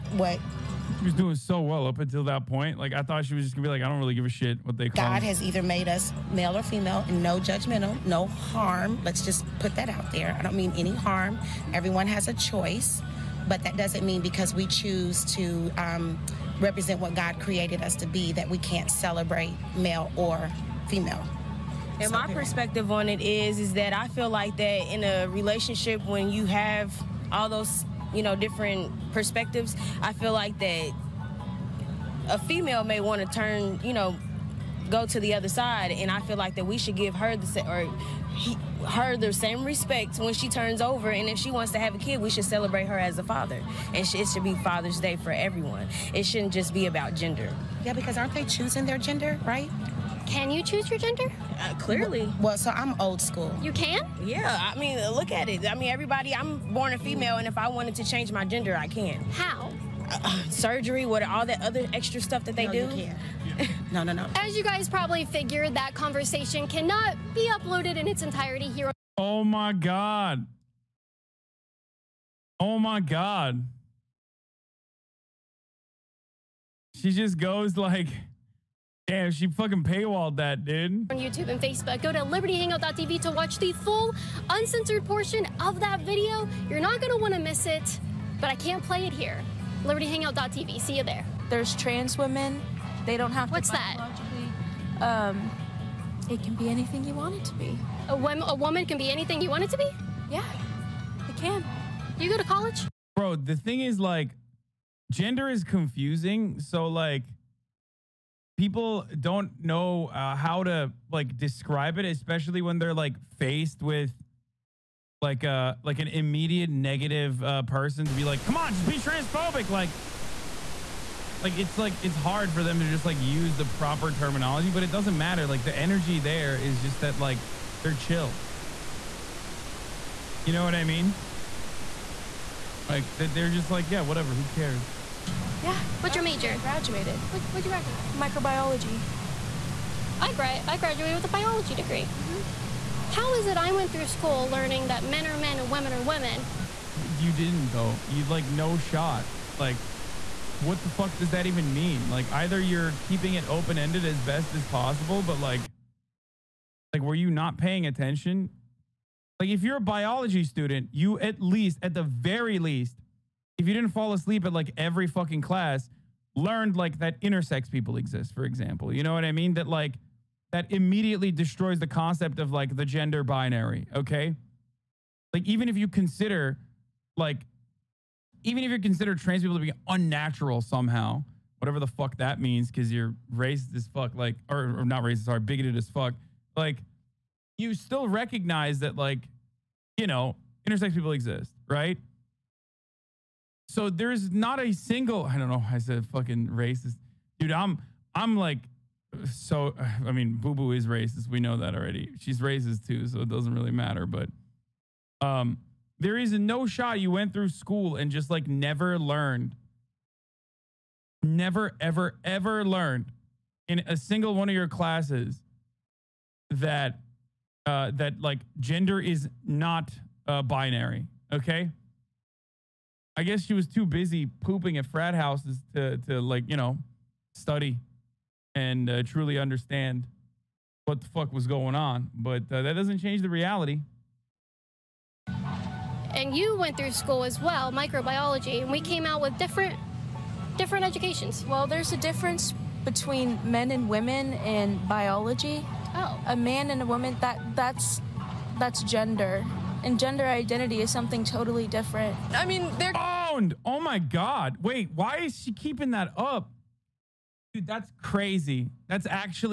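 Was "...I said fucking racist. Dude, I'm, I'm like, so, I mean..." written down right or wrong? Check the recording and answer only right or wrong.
right.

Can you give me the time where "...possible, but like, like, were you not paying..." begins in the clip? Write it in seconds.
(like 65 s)
154 s.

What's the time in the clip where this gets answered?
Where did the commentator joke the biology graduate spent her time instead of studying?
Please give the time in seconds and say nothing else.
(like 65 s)
224 s.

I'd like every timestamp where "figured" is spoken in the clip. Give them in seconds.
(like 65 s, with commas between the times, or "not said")
65 s.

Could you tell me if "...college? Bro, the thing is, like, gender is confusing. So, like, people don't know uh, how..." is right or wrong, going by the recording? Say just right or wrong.
right.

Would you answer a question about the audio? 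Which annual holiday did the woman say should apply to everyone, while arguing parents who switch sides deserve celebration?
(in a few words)
Father's Day.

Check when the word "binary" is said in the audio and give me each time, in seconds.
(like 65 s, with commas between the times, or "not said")
173 s, 220 s.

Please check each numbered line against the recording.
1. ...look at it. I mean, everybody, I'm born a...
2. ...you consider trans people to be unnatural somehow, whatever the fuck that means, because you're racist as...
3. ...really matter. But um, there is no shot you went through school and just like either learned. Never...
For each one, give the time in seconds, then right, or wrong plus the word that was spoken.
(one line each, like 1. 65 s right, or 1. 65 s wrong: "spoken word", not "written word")
1. 55 s right
2. 178 s right
3. 203 s wrong: "never", not "either".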